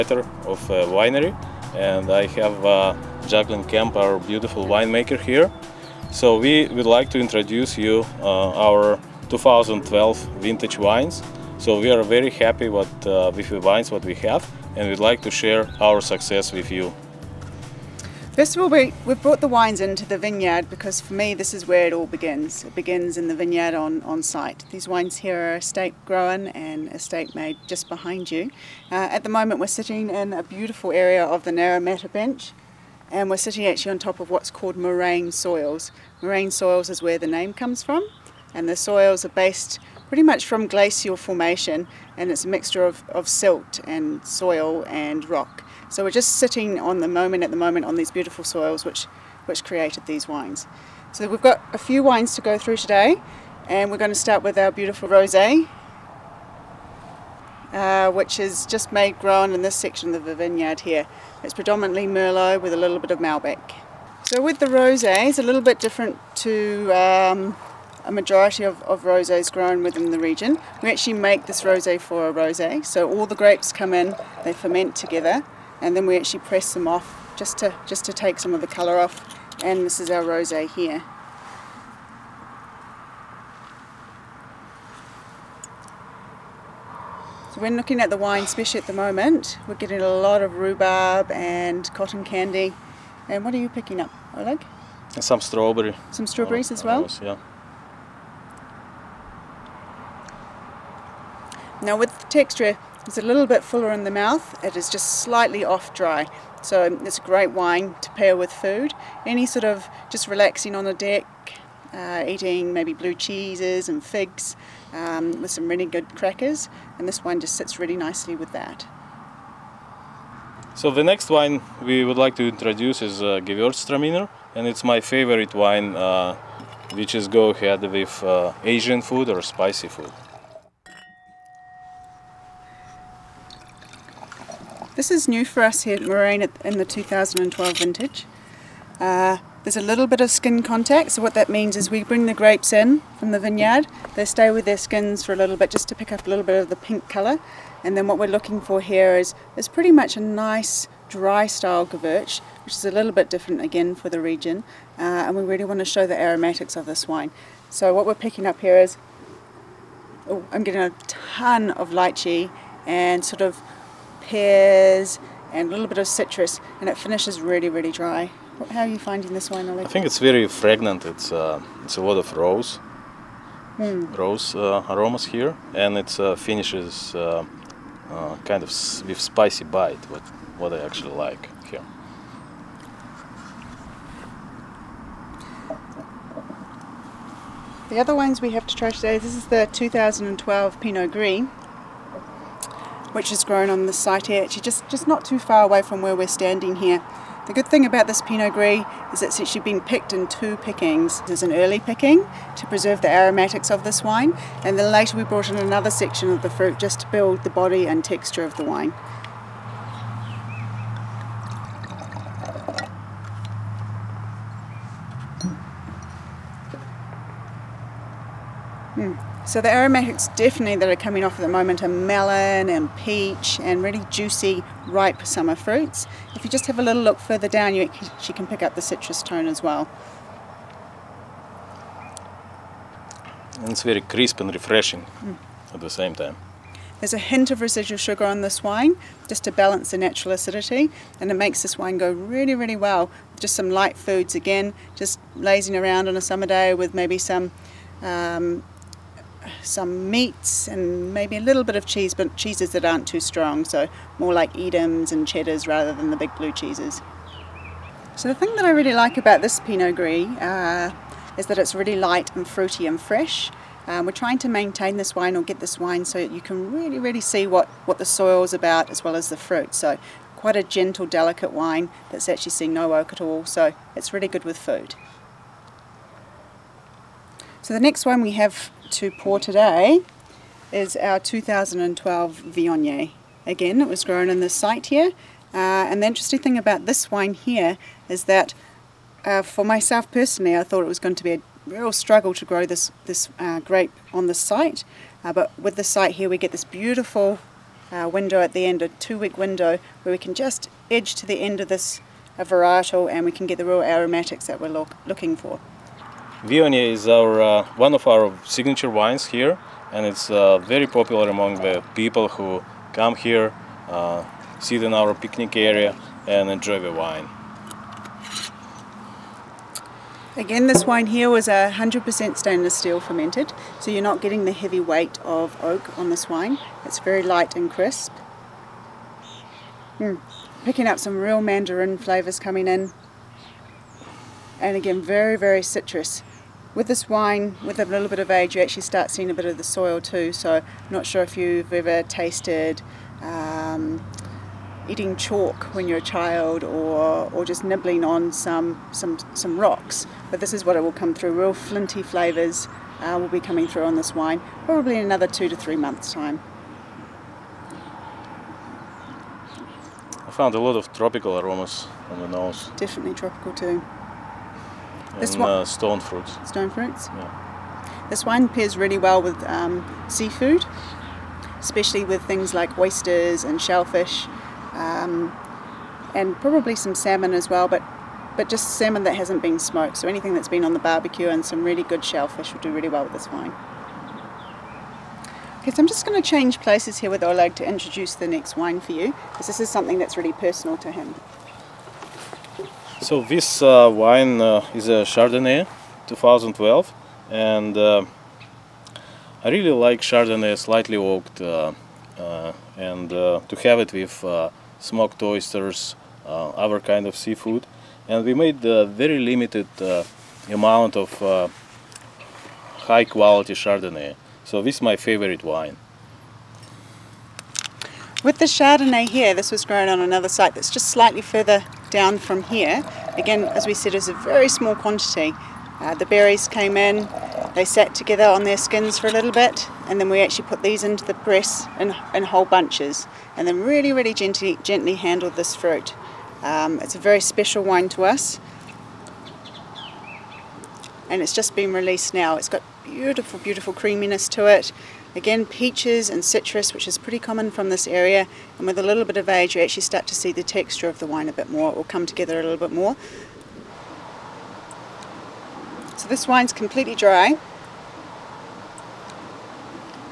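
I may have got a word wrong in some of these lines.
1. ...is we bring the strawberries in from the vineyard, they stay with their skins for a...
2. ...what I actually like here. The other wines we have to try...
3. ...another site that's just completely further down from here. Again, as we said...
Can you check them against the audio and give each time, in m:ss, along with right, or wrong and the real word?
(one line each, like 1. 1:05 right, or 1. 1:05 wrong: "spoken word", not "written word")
1. 2:21 wrong: "grapes", not "strawberries"
2. 3:00 right
3. 7:00 wrong: "slightly", not "completely".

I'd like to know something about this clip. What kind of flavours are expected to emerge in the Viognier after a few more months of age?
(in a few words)
Flinty.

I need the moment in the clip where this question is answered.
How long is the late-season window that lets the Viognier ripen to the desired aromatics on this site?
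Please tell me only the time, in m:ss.
4:58.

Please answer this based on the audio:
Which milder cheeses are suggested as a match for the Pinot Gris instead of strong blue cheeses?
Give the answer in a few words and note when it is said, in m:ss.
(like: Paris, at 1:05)
Edams and cheddars, at 4:14.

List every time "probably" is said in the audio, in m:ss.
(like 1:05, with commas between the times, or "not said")
5:54, 6:16.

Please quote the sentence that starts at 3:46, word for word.
If you just have a little look further down you actually can pick up the citrus tone as well.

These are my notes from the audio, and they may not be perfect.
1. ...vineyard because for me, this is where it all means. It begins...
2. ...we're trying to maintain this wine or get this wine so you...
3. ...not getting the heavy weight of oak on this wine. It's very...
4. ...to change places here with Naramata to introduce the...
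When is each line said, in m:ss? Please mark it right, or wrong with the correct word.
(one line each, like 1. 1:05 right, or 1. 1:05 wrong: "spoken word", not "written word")
1. 0:20 wrong: "begins", not "means"
2. 4:24 right
3. 5:24 right
4. 6:26 wrong: "Oleg", not "Naramata".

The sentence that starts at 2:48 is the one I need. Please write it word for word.
How are you finding this wine, Oleg?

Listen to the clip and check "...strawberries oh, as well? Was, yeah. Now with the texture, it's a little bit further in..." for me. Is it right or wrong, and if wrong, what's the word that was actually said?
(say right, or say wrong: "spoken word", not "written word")
wrong: "fuller", not "further".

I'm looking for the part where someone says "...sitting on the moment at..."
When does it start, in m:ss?
0:46.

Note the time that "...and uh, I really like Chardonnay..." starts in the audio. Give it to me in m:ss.
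6:37.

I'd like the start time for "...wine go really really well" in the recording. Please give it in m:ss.
4:01.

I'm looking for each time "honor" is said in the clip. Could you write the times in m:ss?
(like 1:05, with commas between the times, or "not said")
not said.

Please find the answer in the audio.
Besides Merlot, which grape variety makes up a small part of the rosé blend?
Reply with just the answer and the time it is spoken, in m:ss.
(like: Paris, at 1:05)
Malbec, at 1:03.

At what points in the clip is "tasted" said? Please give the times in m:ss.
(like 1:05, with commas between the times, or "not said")
5:42.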